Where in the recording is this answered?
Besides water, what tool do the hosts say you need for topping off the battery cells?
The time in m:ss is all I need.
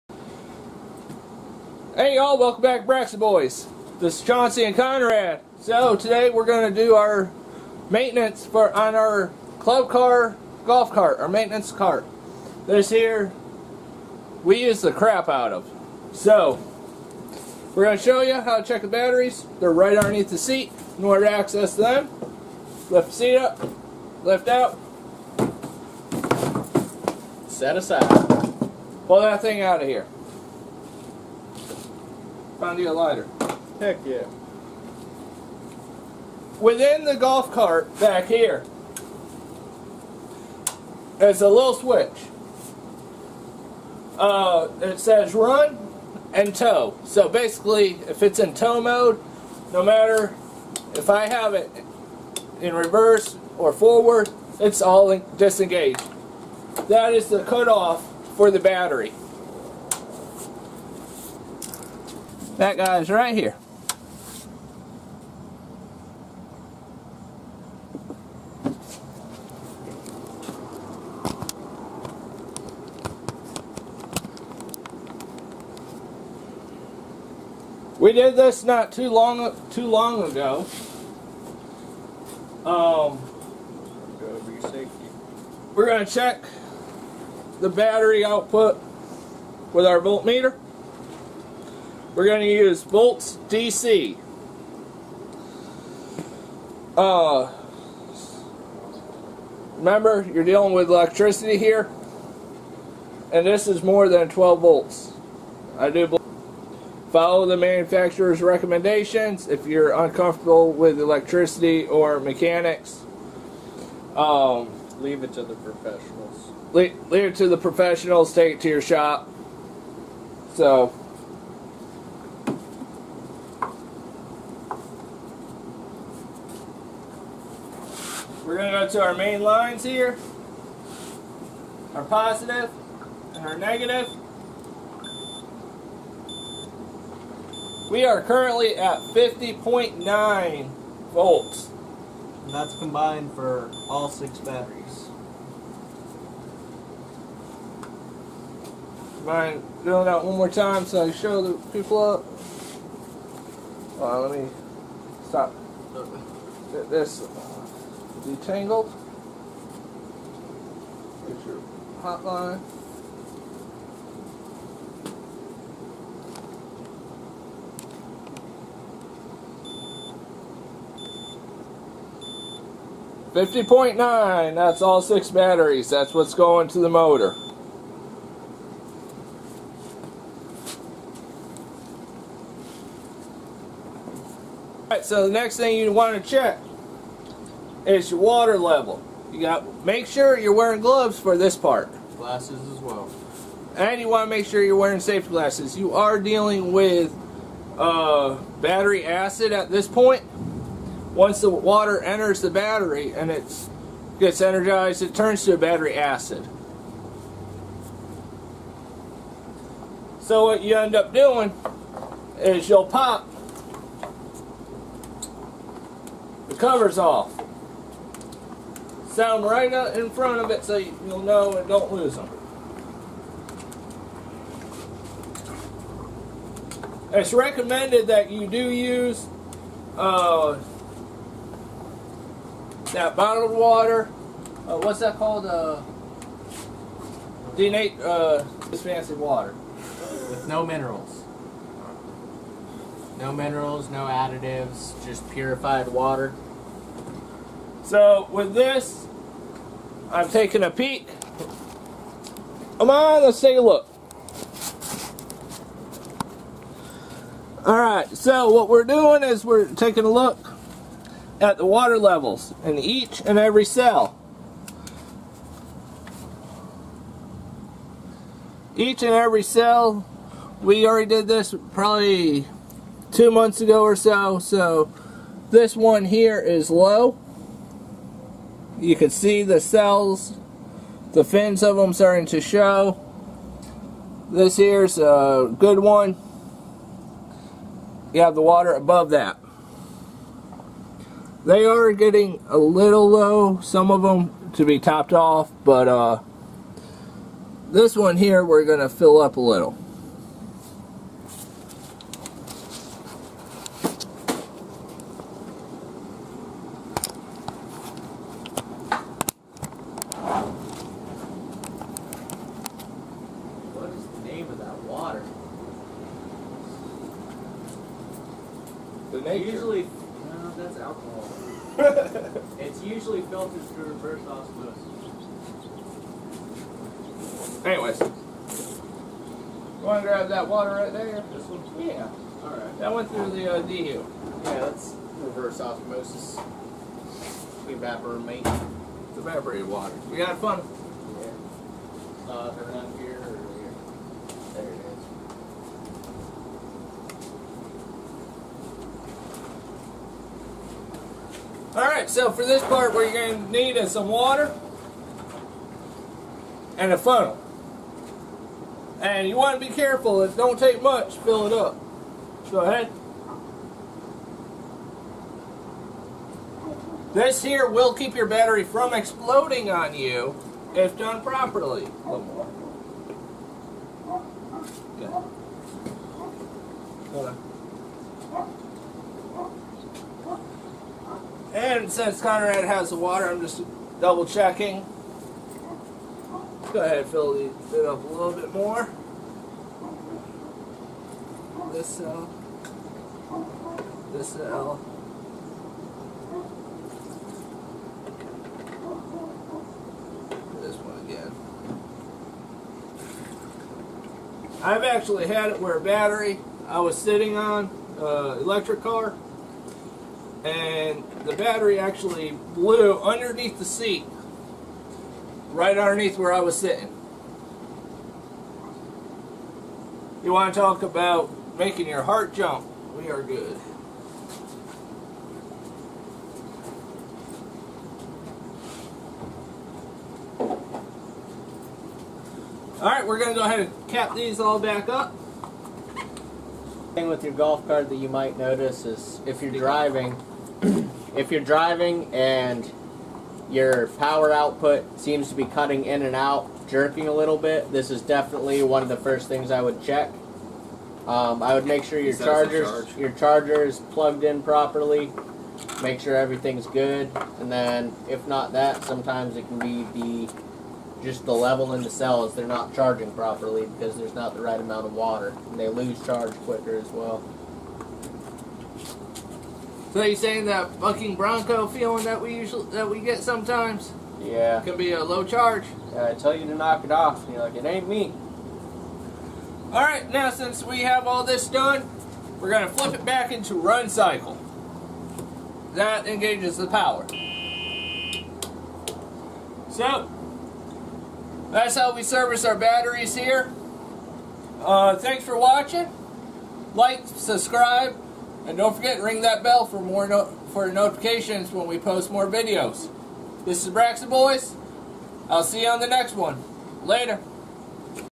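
5:56.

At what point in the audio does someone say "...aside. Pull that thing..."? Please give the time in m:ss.
0:27.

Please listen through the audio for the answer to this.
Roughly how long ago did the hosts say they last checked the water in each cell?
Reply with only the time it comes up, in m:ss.
4:33.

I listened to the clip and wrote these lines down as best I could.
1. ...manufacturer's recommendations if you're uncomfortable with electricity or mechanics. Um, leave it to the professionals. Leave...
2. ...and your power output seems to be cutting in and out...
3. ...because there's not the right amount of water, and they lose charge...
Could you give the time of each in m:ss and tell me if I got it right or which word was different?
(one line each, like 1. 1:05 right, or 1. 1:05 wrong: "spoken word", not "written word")
1. 1:47 right
2. 7:22 right
3. 7:43 right.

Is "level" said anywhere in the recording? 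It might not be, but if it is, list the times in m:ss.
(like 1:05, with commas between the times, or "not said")
3:08, 4:21, 7:41.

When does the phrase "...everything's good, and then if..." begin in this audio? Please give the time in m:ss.
7:36.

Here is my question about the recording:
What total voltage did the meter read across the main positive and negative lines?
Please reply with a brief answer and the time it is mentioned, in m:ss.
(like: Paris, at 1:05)
50.9 volts, at 2:18.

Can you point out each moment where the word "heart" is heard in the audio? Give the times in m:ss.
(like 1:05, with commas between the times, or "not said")
7:02.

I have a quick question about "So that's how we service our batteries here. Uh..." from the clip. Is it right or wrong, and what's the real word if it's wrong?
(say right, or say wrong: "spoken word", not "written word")
right.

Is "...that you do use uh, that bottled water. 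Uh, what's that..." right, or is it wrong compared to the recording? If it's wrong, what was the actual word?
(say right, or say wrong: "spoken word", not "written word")
right.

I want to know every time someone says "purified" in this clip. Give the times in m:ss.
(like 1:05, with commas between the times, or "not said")
4:05.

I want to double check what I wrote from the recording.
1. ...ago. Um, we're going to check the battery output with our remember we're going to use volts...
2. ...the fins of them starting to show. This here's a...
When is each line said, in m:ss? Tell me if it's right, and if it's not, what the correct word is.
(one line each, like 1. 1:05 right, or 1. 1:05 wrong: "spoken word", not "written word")
1. 1:20 wrong: "voltmeter", not "remember"
2. 4:41 right.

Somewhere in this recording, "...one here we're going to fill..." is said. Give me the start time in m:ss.
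4:57.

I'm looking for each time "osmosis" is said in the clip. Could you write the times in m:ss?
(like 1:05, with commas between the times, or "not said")
5:24, 5:35.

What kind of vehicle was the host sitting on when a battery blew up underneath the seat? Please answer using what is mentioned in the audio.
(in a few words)
electric car.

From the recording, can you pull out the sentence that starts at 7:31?
Um, I would make sure your chargers charge.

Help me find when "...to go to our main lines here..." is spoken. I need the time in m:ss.
2:08.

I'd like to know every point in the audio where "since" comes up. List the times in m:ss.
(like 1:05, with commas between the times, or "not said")
6:21, 8:00.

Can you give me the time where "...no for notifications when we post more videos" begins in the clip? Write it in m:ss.
8:20.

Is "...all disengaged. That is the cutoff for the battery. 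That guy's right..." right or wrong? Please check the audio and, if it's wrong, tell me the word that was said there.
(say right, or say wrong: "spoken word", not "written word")
right.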